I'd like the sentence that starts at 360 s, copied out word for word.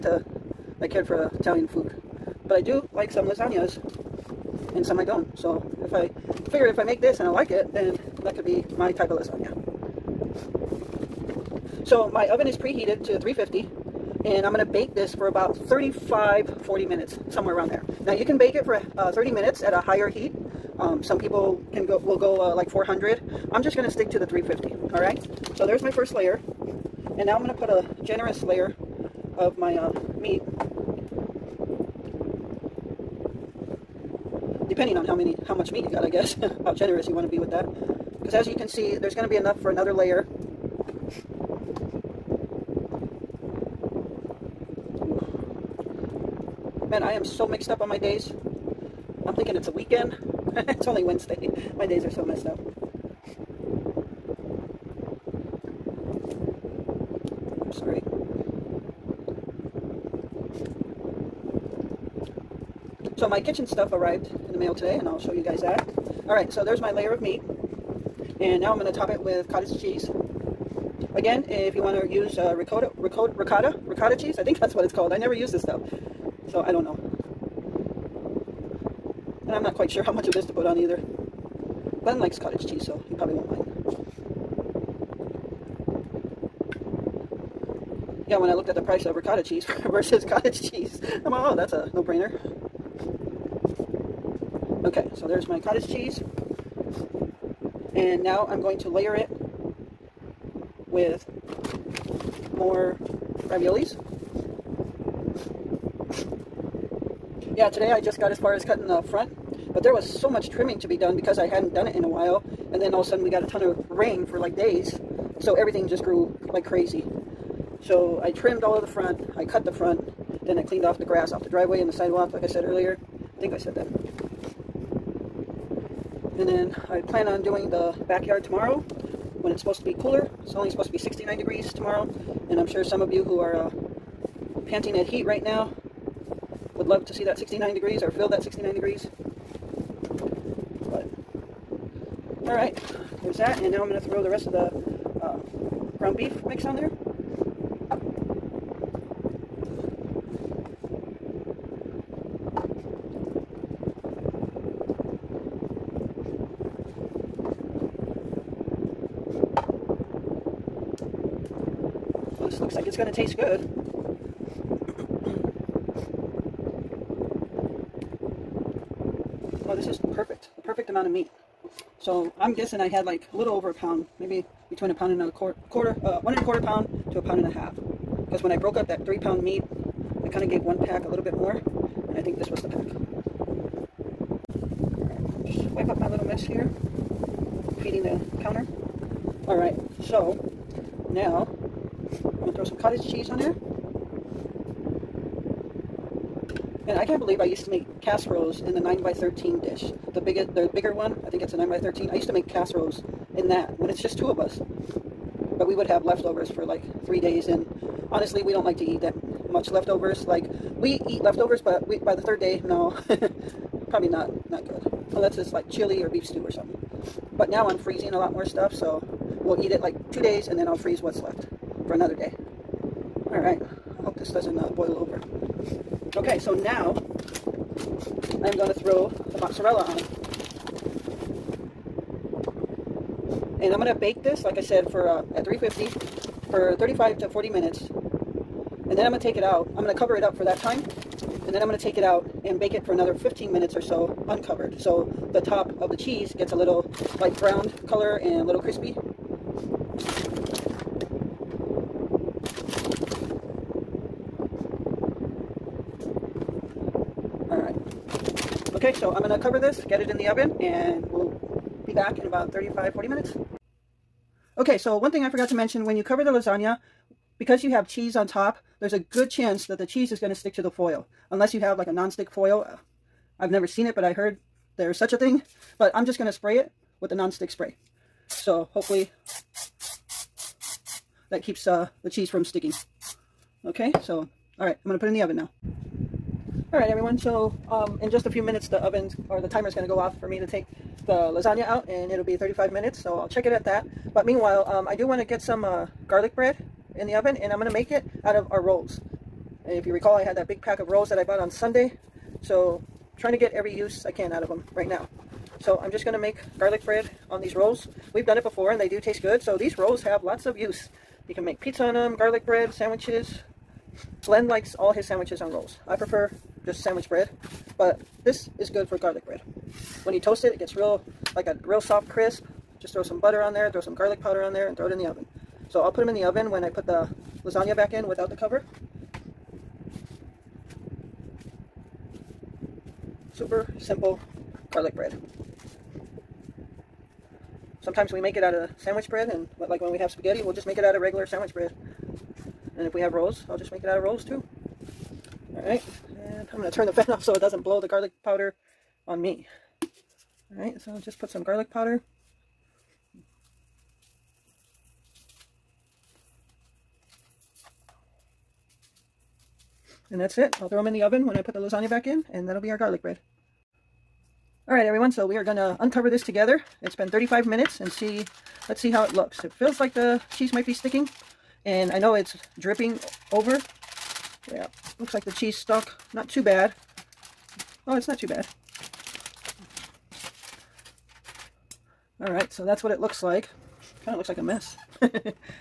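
I'll throw them in the oven when I put the lasagna back in, and that'll be our garlic bread.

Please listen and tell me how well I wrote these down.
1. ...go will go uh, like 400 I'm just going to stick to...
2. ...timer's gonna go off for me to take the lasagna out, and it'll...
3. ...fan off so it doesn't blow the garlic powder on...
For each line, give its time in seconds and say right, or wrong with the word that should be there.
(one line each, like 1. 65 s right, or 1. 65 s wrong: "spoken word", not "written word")
1. 21 s right
2. 289 s right
3. 346 s right.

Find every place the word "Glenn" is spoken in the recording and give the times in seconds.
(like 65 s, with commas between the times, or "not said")
82 s, 314 s.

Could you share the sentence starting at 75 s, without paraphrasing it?
I never use this stuff, so I don't know.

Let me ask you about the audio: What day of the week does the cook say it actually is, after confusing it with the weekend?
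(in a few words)
Wednesday.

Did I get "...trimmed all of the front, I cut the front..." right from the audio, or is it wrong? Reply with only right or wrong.
right.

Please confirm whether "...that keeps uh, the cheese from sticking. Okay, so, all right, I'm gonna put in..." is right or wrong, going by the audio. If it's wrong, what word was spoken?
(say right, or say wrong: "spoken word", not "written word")
right.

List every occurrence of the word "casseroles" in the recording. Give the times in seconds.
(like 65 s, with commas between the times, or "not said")
198 s, 202 s.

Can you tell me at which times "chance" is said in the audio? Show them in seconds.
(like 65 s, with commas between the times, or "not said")
269 s.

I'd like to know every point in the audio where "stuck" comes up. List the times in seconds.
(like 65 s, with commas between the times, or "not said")
375 s.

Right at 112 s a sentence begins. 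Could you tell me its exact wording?
And then all of a sudden we got a ton of rain for like days.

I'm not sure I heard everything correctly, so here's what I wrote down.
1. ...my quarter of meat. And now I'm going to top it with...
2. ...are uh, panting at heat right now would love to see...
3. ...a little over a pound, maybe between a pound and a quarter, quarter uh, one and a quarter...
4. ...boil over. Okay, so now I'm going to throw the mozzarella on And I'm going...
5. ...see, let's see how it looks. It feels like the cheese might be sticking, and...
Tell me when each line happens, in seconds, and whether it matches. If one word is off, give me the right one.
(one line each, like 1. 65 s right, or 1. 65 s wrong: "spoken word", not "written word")
1. 66 s wrong: "layer", not "quarter"
2. 133 s right
3. 173 s right
4. 224 s right
5. 367 s right.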